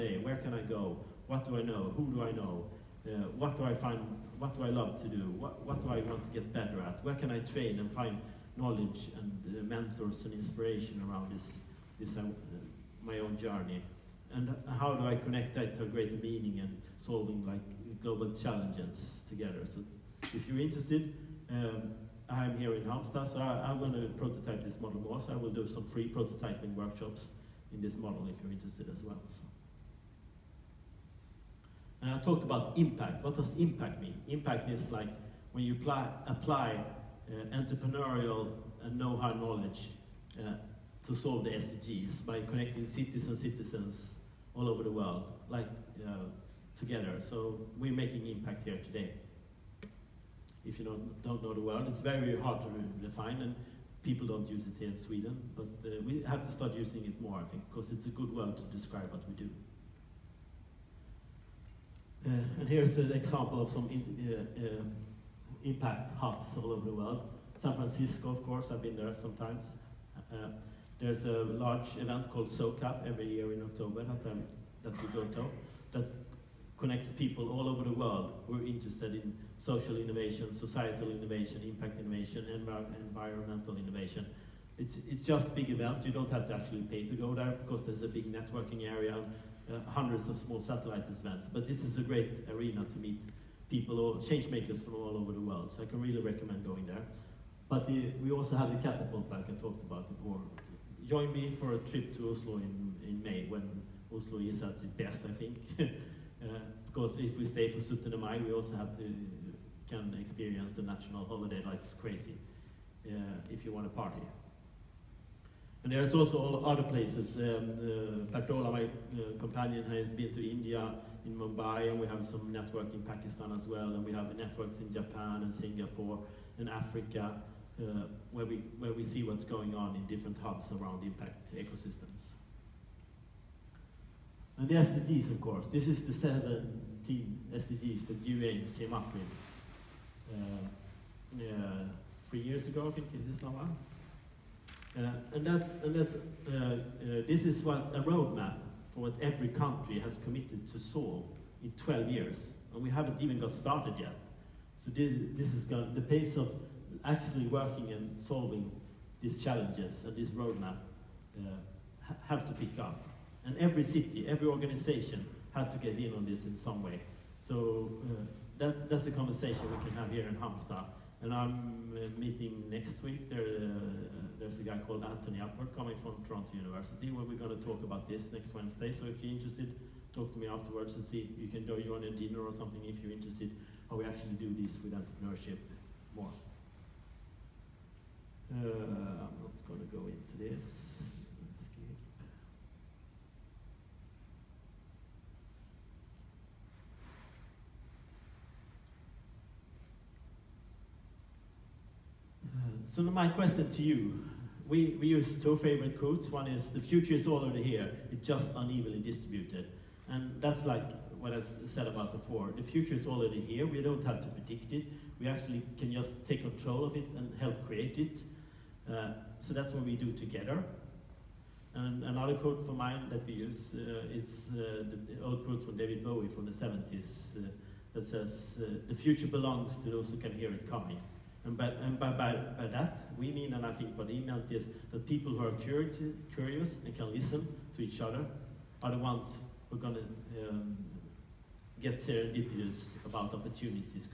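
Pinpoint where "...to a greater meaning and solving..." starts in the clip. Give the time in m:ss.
0:15.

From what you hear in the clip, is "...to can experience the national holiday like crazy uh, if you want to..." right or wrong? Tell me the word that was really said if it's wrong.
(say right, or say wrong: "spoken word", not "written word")
right.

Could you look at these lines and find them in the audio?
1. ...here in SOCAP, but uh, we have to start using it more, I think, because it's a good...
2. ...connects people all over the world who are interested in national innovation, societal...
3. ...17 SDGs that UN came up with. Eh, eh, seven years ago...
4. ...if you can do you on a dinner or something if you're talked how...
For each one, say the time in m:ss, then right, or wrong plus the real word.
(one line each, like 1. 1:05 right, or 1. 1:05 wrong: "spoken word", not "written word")
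1. 0:54 wrong: "Sweden", not "SOCAP"
2. 1:16 wrong: "social", not "national"
3. 2:16 wrong: "three", not "seven"
4. 3:01 wrong: "interested", not "talked".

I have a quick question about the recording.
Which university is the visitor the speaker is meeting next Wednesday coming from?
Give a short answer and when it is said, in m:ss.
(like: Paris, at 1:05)
Toronto University, at 2:56.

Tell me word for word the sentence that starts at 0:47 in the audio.
So we're making impact here today if you don't, don't know the word.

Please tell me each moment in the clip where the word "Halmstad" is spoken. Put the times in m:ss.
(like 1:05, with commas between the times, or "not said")
0:22, 2:50.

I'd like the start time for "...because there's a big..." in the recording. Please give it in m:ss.
1:27.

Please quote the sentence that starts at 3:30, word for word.
And that's like what I said about before.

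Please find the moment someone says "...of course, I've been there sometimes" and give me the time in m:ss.
1:08.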